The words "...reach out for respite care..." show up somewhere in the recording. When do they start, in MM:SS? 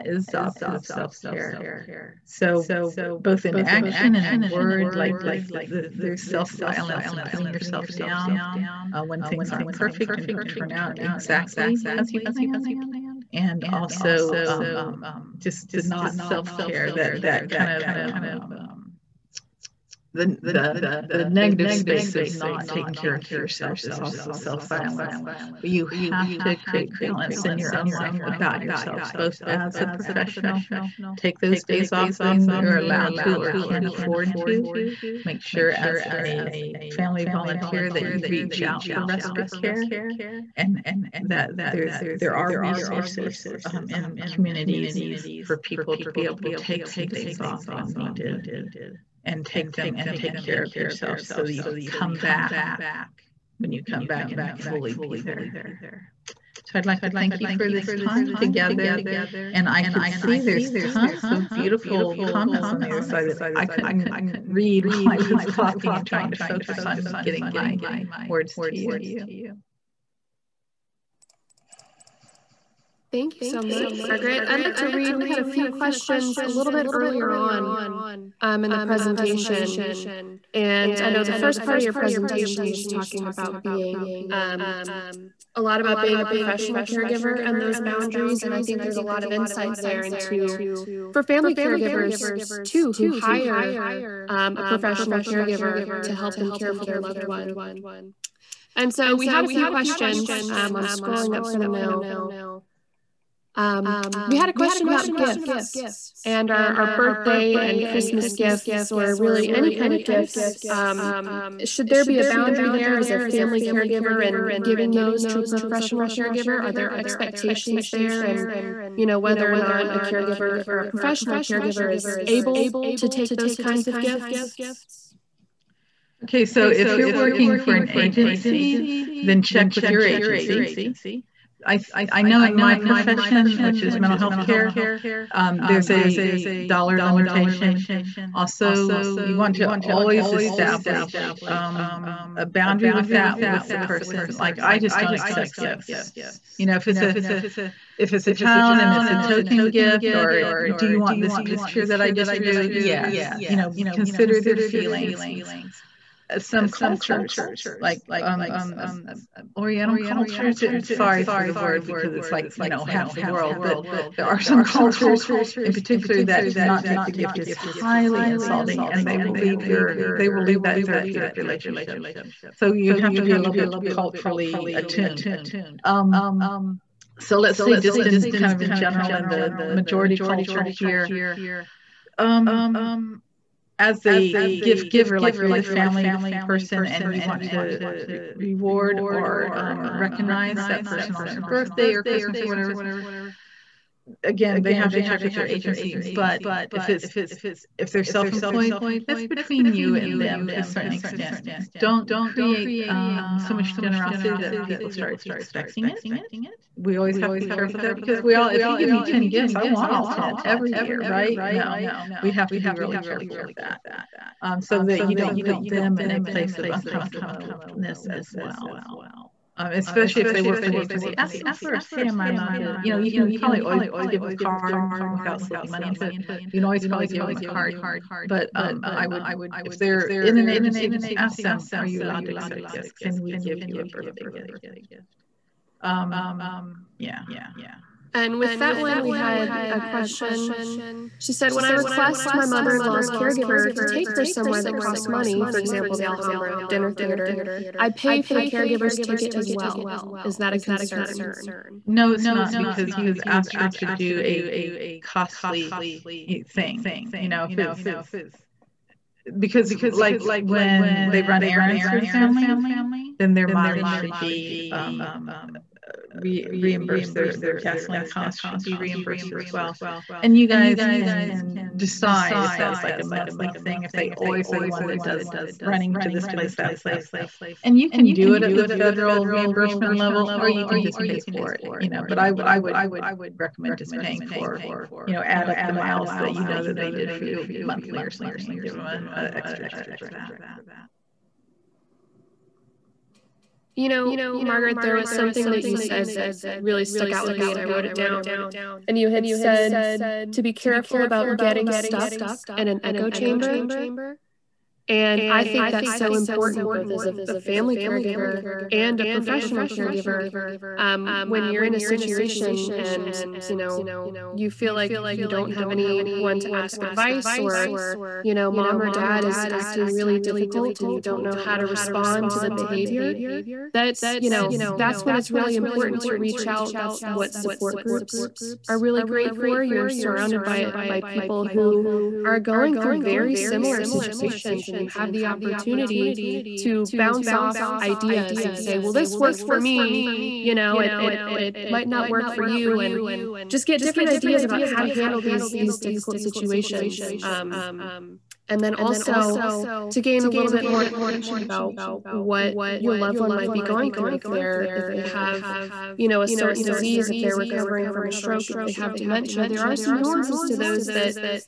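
00:38.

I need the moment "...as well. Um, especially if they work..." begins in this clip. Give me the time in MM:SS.
03:38.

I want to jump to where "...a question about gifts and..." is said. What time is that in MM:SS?
01:44.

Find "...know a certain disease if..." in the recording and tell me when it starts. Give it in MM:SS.
05:56.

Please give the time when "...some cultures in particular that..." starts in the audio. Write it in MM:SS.
02:44.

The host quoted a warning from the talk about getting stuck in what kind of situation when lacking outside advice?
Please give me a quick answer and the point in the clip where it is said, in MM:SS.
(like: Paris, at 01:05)
an echo chamber, at 05:02.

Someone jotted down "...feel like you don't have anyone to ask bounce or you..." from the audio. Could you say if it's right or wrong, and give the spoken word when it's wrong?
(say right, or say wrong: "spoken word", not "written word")
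wrong: "advice", not "bounce".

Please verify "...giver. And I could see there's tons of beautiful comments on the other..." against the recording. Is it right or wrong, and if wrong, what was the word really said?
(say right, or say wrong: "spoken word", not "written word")
wrong: "together", not "giver".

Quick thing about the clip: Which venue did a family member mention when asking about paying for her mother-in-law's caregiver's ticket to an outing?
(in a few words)
Alhambra dinner theater.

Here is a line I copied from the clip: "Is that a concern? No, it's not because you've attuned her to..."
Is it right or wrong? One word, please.
wrong.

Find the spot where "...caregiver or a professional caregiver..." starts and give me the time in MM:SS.
01:59.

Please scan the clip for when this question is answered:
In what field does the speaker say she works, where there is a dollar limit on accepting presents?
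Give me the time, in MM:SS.
02:13.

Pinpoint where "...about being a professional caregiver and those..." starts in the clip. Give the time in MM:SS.
01:25.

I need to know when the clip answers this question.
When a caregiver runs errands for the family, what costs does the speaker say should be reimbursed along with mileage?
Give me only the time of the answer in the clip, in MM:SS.
04:27.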